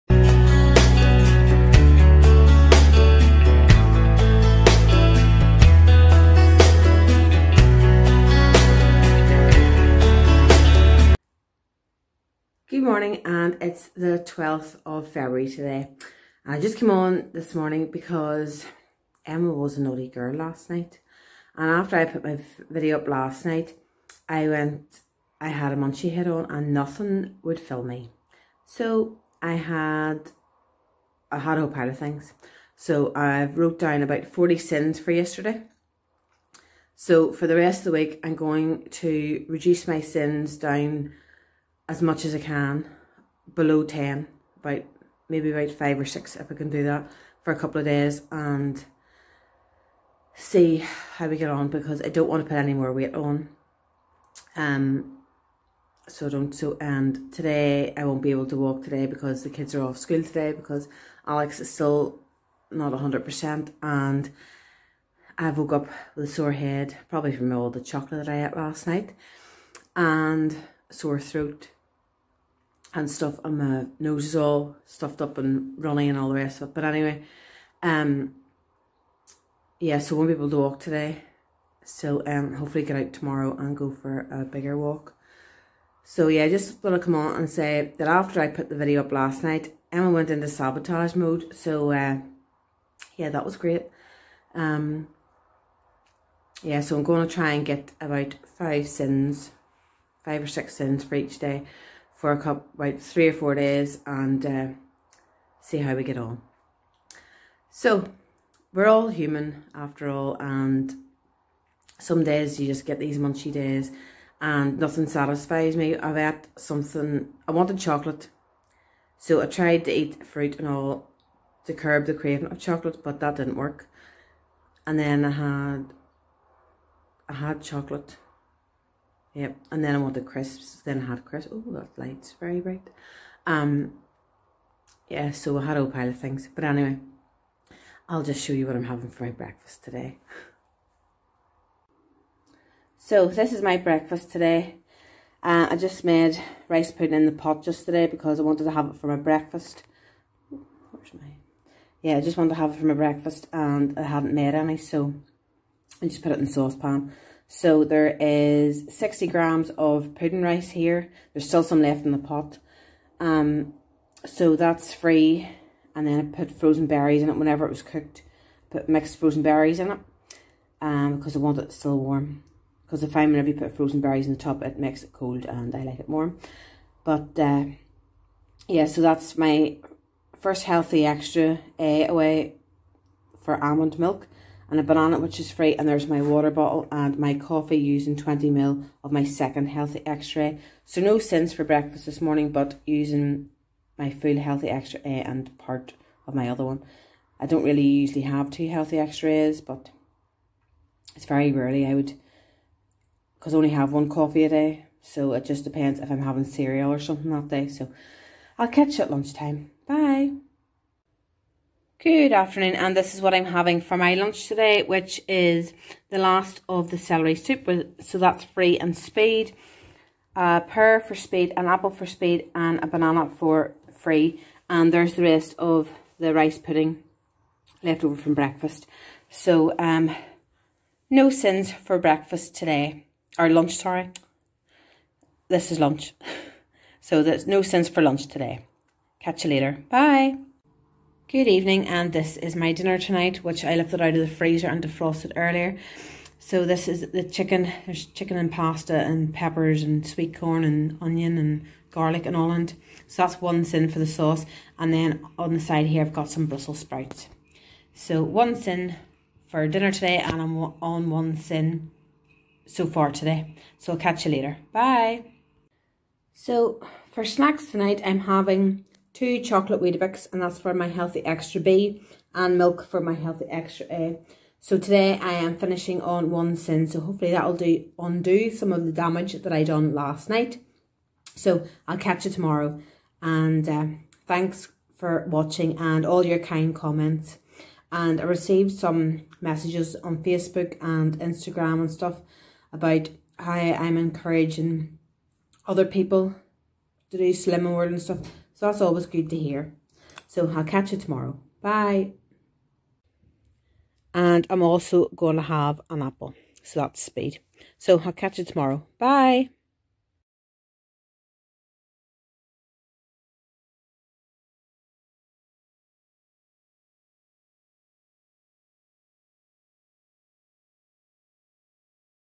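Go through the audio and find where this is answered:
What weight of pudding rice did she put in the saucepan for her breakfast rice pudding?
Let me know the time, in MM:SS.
02:38.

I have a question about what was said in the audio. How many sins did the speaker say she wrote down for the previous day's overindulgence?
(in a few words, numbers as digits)
40.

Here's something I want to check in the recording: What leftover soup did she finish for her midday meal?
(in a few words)
celery soup.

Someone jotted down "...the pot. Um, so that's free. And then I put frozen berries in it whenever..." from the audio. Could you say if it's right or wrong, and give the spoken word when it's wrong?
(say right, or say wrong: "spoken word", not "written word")
right.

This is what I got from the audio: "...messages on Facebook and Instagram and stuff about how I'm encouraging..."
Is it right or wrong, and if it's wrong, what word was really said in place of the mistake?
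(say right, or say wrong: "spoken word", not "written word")
right.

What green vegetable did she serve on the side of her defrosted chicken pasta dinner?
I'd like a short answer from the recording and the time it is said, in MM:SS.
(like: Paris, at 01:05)
Brussels sprouts, at 04:16.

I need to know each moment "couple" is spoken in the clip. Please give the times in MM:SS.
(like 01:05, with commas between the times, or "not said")
00:47, 01:42.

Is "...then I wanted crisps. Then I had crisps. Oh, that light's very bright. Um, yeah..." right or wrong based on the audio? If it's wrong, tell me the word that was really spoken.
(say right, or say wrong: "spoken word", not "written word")
right.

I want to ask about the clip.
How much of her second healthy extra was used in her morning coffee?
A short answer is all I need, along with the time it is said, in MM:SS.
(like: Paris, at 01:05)
20ml, at 03:08.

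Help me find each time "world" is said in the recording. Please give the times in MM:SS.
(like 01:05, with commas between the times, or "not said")
04:57.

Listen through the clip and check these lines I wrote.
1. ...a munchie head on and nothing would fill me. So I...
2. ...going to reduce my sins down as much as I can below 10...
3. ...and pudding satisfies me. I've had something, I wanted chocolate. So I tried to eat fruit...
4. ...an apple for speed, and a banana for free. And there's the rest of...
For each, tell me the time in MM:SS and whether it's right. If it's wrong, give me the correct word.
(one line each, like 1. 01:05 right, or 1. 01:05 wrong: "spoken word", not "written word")
1. 00:25 right
2. 00:38 right
3. 01:54 wrong: "nothing", not "pudding"
4. 03:41 right.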